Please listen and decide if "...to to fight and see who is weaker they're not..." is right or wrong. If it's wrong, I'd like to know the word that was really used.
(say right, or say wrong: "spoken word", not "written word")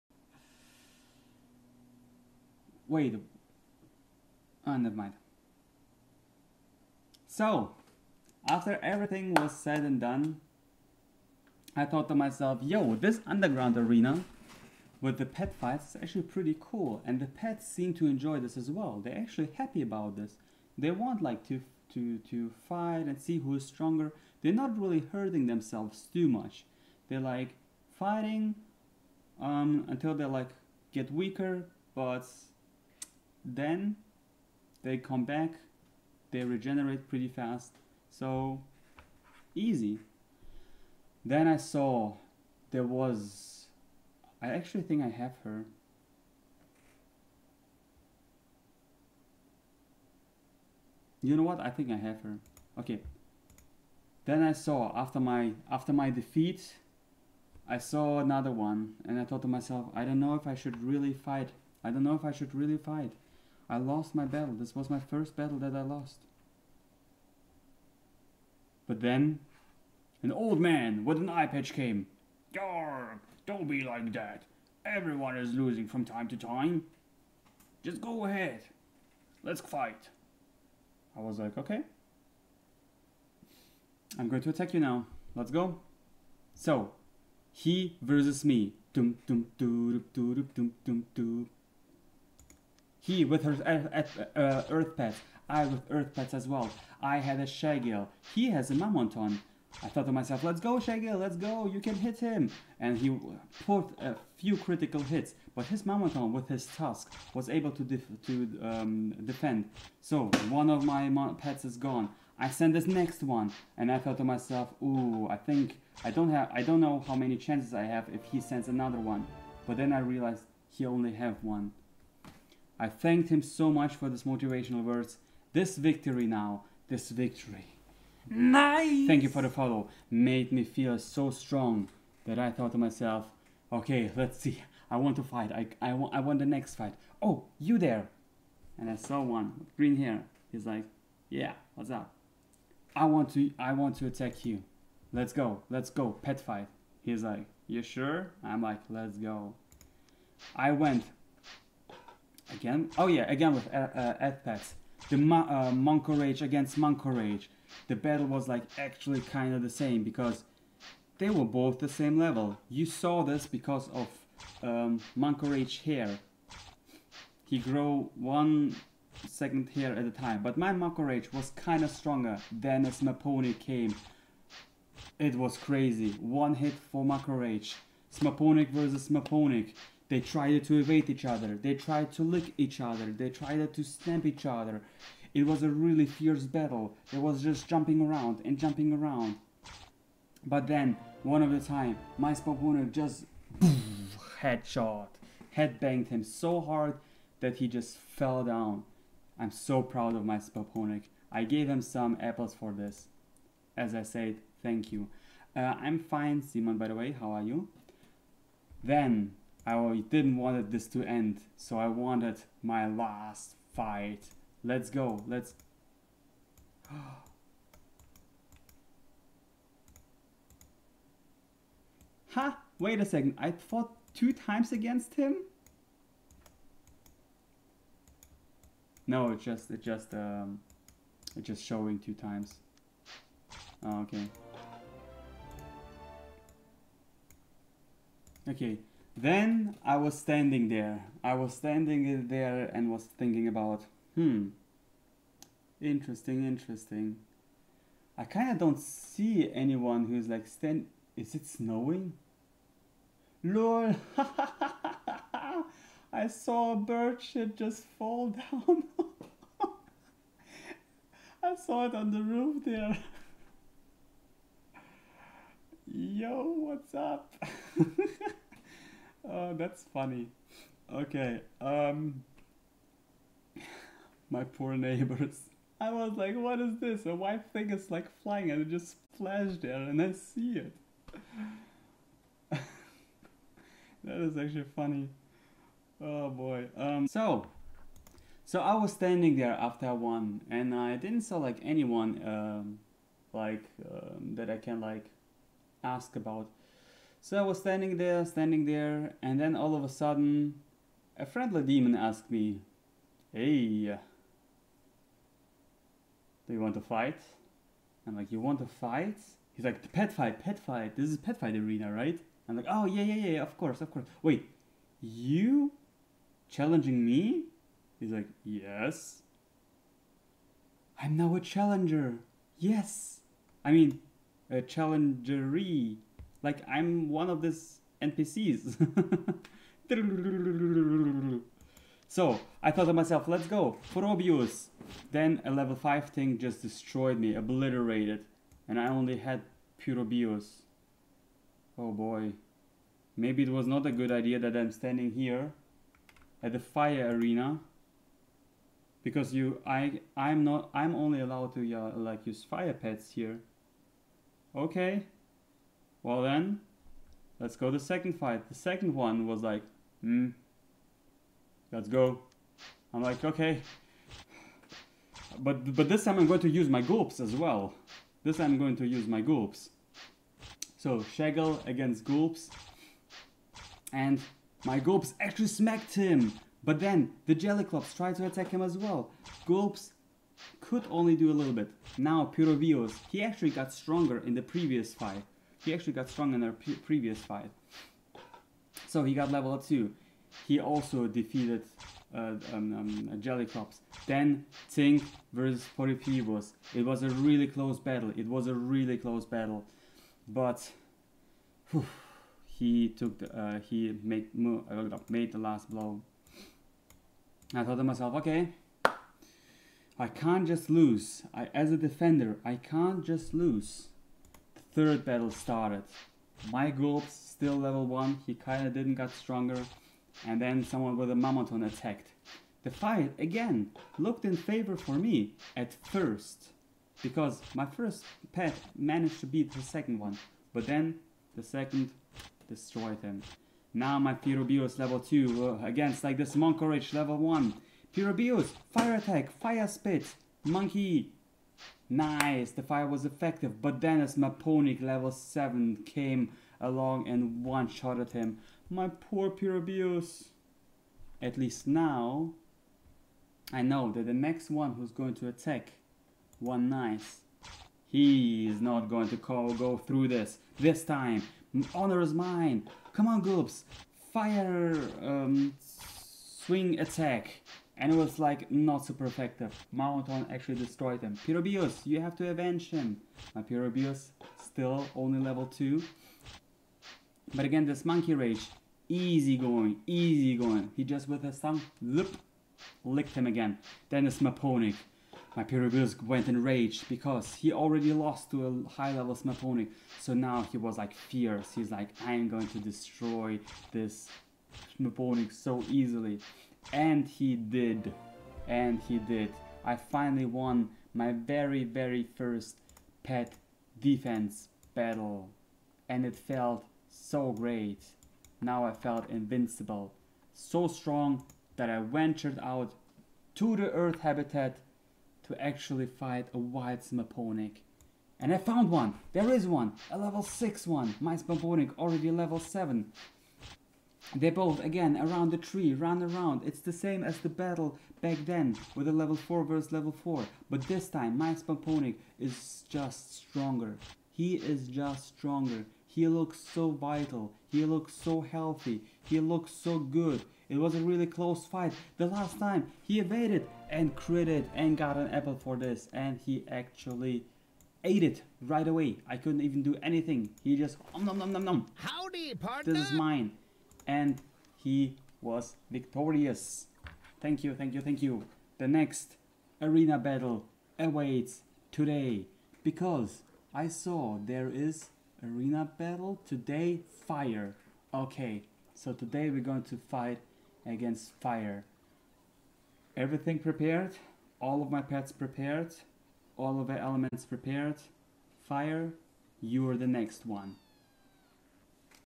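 wrong: "stronger", not "weaker".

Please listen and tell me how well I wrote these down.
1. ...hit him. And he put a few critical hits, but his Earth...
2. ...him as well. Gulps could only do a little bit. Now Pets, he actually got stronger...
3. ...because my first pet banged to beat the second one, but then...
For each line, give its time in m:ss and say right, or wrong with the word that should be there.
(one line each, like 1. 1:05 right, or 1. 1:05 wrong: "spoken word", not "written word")
1. 1:41 wrong: "Mamoton", not "Earth"
2. 6:18 wrong: "Pyrobius", not "Pets"
3. 7:07 wrong: "managed", not "banged".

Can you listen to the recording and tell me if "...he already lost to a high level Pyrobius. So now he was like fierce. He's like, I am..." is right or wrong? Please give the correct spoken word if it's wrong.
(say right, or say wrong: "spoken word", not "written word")
wrong: "Smaponic", not "Pyrobius".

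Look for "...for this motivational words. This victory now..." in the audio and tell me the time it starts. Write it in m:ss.
2:03.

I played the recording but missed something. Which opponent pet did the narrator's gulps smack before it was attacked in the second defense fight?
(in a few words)
Shagel.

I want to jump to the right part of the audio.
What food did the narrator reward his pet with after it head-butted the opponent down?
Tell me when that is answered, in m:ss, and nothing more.
3:22.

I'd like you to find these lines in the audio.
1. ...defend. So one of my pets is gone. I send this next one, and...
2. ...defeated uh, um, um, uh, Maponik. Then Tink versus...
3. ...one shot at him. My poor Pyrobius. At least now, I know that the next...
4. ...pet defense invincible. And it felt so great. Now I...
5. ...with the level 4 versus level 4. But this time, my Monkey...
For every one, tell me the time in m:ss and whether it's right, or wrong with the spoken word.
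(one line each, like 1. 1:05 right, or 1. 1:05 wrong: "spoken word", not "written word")
1. 1:49 right
2. 6:31 wrong: "Jellyclops", not "Maponik"
3. 7:27 right
4. 8:23 wrong: "battle", not "invincible"
5. 8:48 wrong: "Spomponic", not "Monkey".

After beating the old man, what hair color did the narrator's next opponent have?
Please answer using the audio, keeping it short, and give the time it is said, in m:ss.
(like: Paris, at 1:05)
Green, at 2:19.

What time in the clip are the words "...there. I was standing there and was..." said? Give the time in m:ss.
4:00.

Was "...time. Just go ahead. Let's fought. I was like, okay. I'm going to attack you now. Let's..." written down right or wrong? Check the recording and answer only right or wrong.
wrong.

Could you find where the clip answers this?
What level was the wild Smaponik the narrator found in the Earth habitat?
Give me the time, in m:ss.
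8:39.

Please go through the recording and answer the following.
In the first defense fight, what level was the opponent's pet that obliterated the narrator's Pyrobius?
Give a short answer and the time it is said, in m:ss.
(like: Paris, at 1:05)
5, at 5:35.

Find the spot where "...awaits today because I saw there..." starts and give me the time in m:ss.
9:20.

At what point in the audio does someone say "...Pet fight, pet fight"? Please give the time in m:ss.
5:09.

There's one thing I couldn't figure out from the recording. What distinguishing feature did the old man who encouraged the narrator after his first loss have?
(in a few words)
An eye patch.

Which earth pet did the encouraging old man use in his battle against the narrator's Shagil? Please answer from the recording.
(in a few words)
Mamonton.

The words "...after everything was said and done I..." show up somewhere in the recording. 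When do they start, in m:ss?
0:08.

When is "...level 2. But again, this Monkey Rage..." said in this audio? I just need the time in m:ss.
7:55.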